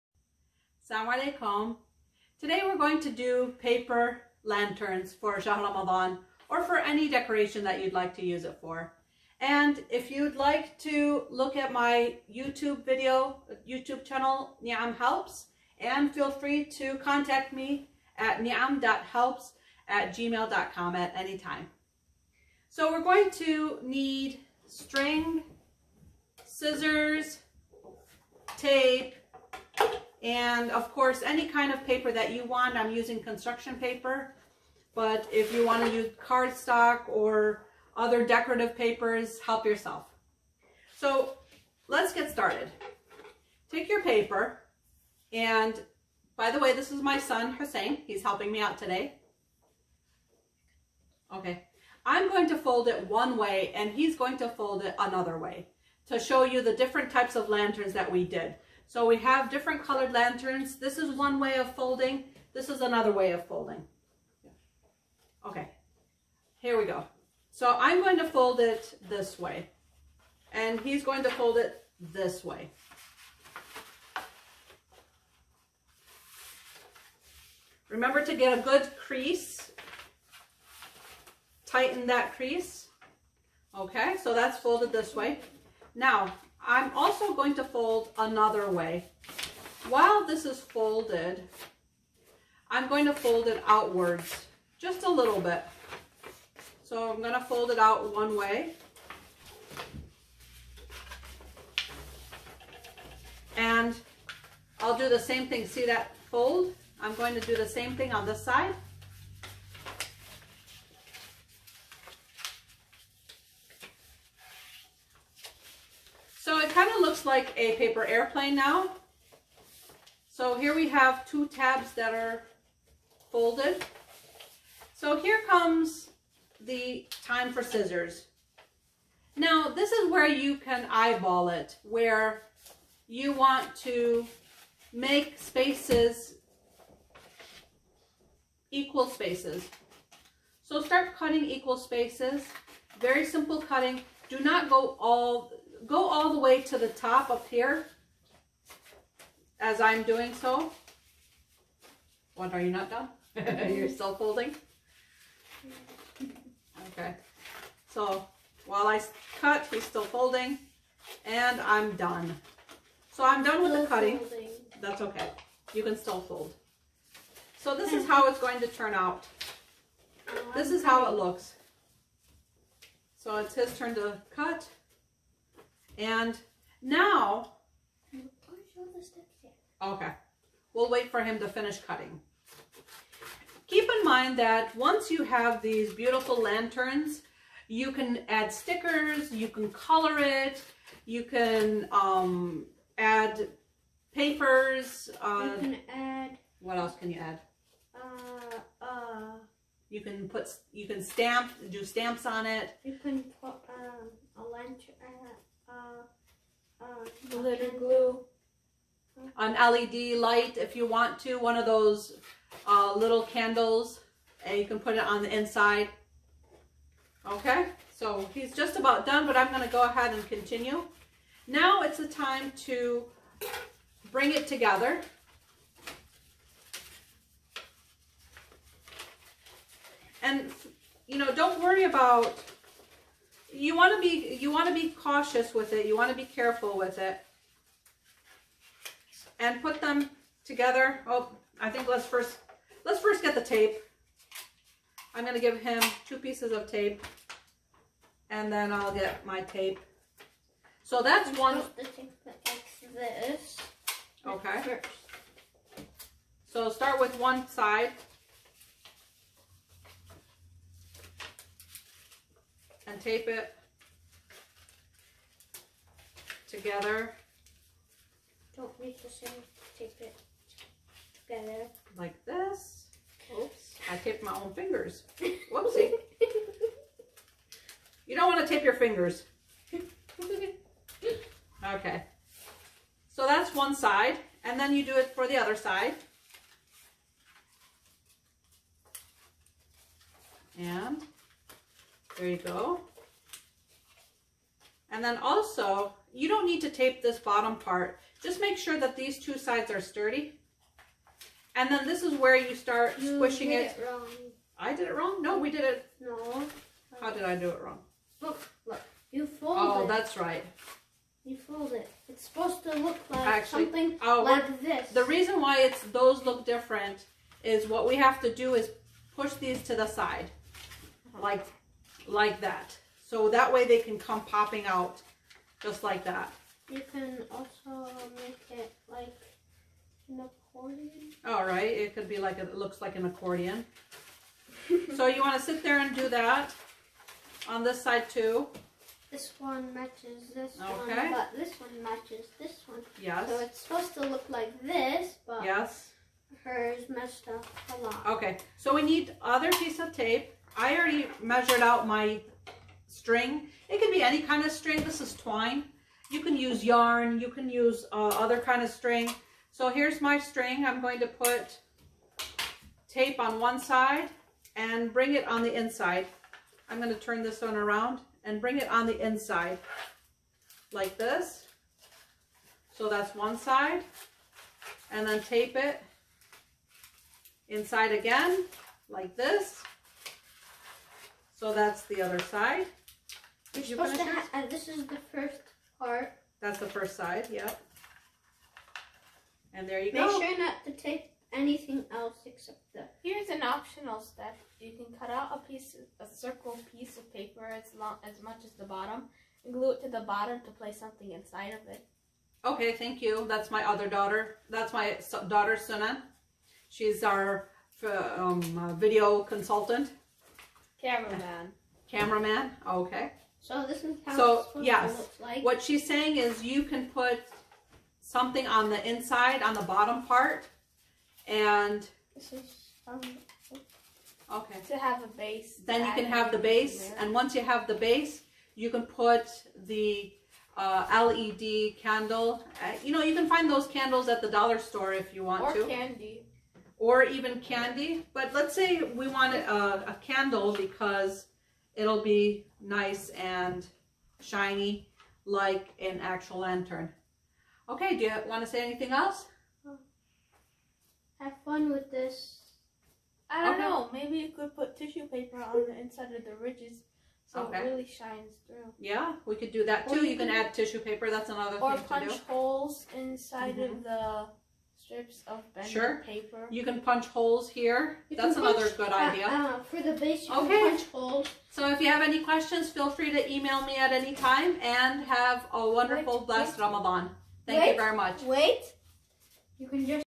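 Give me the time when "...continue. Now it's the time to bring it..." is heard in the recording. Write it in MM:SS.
03:40.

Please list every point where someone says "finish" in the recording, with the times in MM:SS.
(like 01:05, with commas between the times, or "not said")
03:01.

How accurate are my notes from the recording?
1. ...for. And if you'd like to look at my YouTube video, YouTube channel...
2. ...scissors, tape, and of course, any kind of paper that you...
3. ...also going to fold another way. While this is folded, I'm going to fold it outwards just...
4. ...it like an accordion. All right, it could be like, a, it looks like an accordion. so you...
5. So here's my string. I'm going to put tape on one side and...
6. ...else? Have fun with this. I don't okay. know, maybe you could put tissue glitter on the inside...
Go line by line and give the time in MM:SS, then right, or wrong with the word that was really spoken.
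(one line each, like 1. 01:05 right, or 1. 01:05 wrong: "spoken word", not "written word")
1. 00:08 right
2. 00:26 right
3. 01:26 right
4. 05:28 right
5. 05:59 right
6. 07:28 wrong: "paper", not "glitter".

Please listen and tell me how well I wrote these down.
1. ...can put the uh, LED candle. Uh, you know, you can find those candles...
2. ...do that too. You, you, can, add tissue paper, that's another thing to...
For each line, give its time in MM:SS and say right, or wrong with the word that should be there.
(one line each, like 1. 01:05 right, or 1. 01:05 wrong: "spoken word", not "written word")
1. 07:08 right
2. 07:39 right.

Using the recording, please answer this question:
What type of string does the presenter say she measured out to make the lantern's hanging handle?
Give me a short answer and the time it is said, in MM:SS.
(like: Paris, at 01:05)
twine, at 05:55.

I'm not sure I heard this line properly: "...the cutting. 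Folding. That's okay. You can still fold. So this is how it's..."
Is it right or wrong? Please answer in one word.
right.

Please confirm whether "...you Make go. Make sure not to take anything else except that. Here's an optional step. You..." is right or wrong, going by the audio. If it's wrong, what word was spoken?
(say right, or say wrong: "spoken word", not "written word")
right.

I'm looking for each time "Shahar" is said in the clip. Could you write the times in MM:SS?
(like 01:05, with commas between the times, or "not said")
00:05.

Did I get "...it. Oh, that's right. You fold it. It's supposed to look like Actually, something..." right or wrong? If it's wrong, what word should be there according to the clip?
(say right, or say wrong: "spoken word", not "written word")
right.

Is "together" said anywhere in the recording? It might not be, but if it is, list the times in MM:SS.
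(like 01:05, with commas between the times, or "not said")
03:44, 04:00, 04:26, 04:31.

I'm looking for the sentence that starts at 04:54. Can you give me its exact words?
And then also, you don't need to tape this bottom part.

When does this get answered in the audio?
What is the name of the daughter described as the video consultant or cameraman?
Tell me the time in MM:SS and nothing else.
06:45.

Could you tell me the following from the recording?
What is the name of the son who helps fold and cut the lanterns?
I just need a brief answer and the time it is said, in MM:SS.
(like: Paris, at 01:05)
Hussein, at 00:47.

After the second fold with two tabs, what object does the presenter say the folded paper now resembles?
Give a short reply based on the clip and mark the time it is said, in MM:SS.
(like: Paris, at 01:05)
a paper airplane, at 01:57.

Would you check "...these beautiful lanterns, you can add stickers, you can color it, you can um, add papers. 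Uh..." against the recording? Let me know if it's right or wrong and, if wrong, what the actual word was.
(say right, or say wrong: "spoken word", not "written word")
right.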